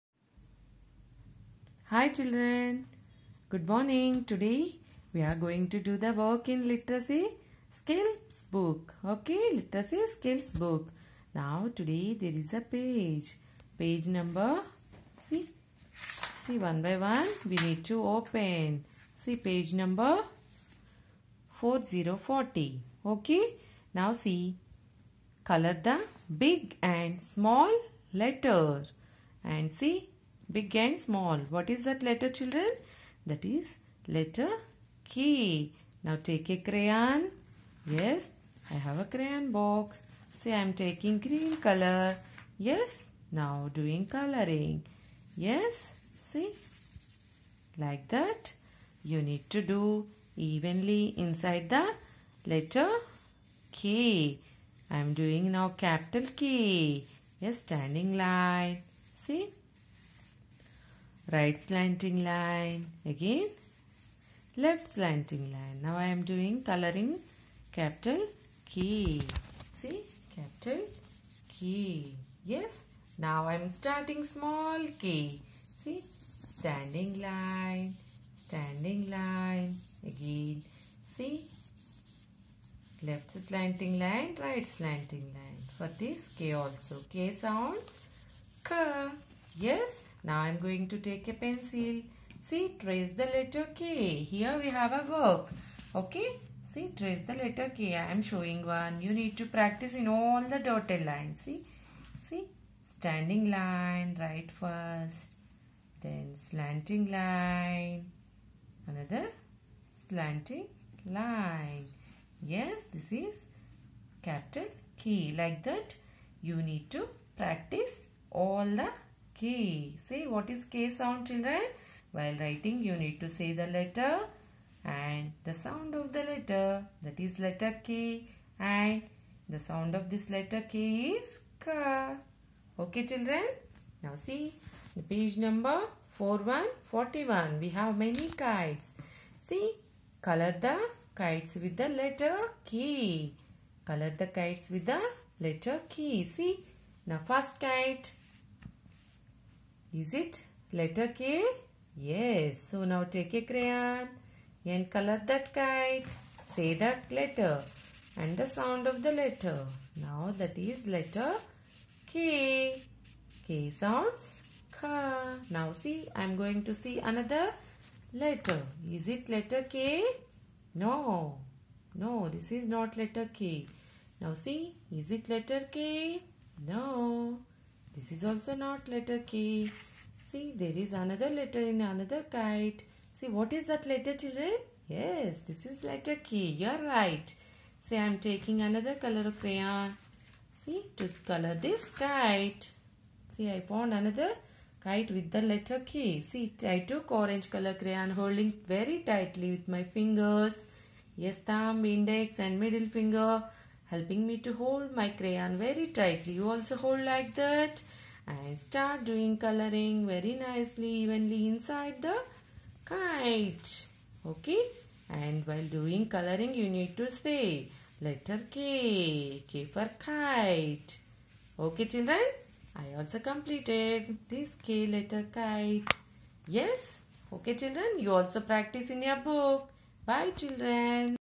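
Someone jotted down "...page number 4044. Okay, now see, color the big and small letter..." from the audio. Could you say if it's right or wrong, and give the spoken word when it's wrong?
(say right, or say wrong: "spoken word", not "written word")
wrong: "4040", not "4044".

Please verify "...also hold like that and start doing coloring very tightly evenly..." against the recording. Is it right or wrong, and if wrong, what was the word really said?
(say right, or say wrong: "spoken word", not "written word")
wrong: "nicely", not "tightly".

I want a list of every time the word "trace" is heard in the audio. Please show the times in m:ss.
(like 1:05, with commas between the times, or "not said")
1:32, 1:36.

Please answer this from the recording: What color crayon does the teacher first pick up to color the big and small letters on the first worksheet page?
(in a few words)
Green.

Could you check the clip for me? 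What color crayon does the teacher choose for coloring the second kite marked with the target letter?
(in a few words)
Orange.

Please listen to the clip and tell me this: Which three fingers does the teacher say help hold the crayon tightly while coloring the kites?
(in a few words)
Thumb, index and middle.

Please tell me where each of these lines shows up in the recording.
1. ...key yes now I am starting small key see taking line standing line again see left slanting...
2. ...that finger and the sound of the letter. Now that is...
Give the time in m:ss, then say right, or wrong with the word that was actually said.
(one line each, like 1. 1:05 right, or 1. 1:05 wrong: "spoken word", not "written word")
1. 1:11 wrong: "standing", not "taking"
2. 2:36 wrong: "letter", not "finger".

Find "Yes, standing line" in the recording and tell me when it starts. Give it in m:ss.
0:57.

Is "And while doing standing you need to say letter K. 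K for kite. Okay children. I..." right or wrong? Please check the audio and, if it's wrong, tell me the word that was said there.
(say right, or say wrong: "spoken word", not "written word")
wrong: "coloring", not "standing".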